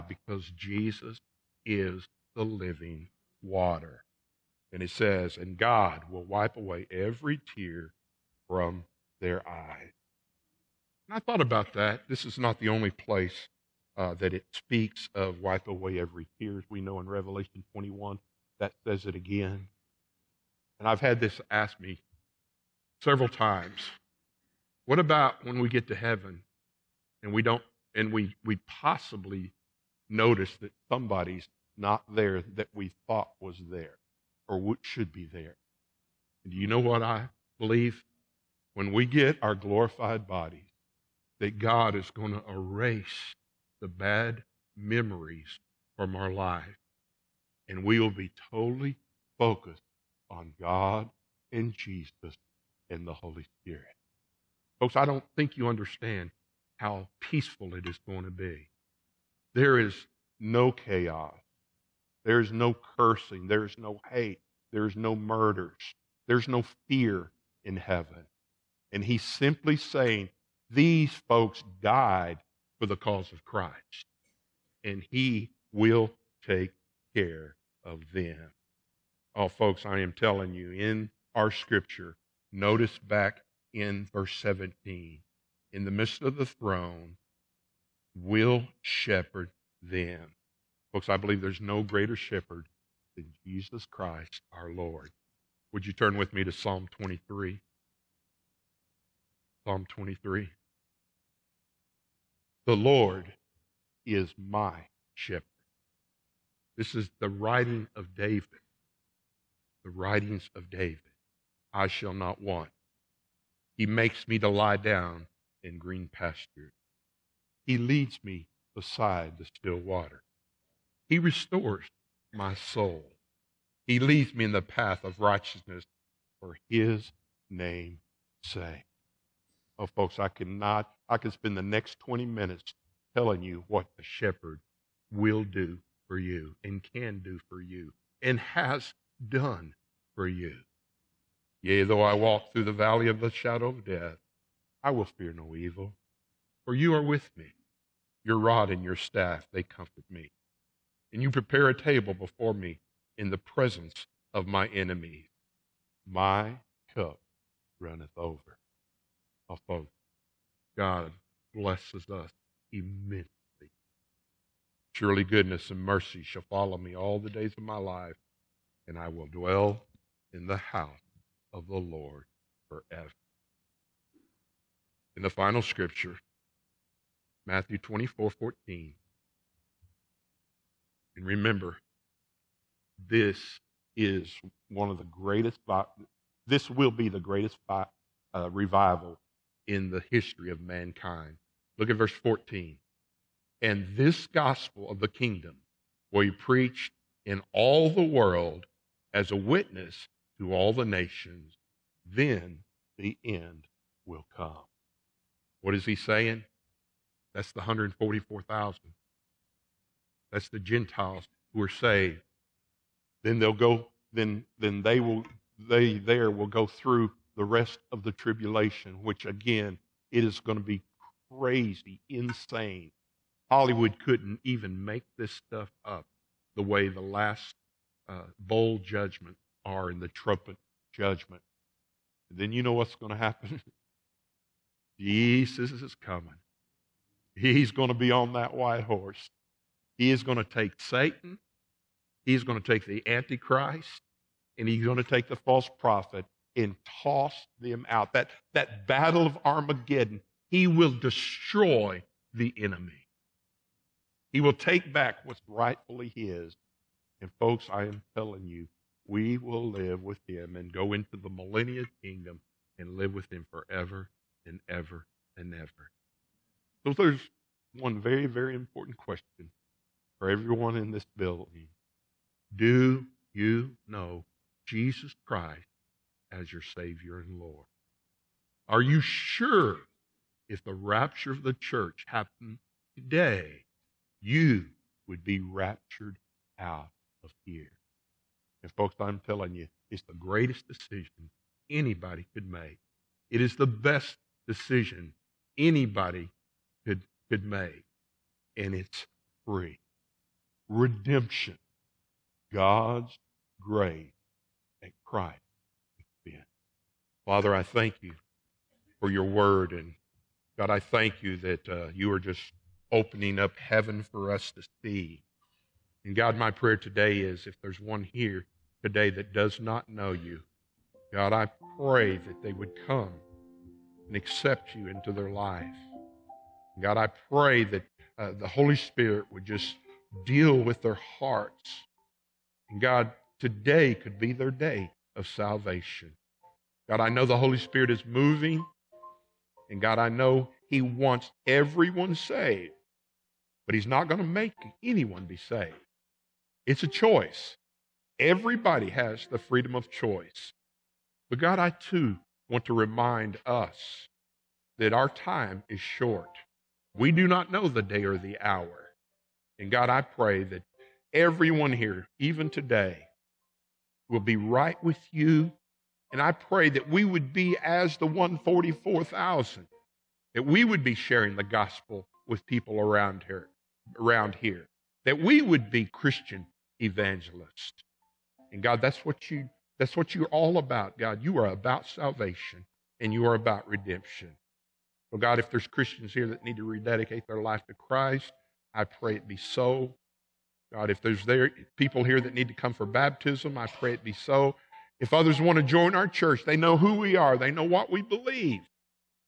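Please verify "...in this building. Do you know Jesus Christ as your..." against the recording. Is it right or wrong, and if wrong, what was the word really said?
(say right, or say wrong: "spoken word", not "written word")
right.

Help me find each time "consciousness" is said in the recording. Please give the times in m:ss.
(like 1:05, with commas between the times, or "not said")
not said.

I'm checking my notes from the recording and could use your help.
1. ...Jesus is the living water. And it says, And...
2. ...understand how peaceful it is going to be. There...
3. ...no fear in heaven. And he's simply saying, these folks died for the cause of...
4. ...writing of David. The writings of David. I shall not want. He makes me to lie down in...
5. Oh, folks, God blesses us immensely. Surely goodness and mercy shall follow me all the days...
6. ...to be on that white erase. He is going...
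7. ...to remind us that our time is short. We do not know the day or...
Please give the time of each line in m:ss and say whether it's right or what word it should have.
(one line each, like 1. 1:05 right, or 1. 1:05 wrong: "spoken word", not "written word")
1. 0:00 right
2. 0:55 right
3. 1:06 right
4. 1:47 right
5. 2:39 right
6. 3:57 wrong: "horse", not "erase"
7. 5:52 right.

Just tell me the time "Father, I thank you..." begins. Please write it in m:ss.
5:07.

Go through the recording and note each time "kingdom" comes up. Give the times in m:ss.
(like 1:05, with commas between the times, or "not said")
3:15, 4:22.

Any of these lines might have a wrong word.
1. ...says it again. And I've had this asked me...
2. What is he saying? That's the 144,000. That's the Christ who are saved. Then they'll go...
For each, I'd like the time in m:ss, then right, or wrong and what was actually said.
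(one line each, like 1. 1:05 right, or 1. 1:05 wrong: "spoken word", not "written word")
1. 0:18 right
2. 3:25 wrong: "Gentiles", not "Christ".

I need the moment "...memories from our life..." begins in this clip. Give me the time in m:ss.
0:44.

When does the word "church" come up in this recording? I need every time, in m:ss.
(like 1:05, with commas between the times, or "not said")
4:41, 6:36.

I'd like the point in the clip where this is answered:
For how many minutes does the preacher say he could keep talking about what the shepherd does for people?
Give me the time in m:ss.
2:11.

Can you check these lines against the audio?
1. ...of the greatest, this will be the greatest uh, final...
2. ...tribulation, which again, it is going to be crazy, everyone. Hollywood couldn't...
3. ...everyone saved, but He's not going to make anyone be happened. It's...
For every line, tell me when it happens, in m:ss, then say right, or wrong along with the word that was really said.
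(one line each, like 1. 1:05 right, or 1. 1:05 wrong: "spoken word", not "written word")
1. 3:04 wrong: "revival", not "final"
2. 3:38 wrong: "insane", not "everyone"
3. 5:41 wrong: "saved", not "happened".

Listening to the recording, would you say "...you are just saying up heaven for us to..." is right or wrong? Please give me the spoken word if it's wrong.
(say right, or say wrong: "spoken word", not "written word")
wrong: "opening", not "saying".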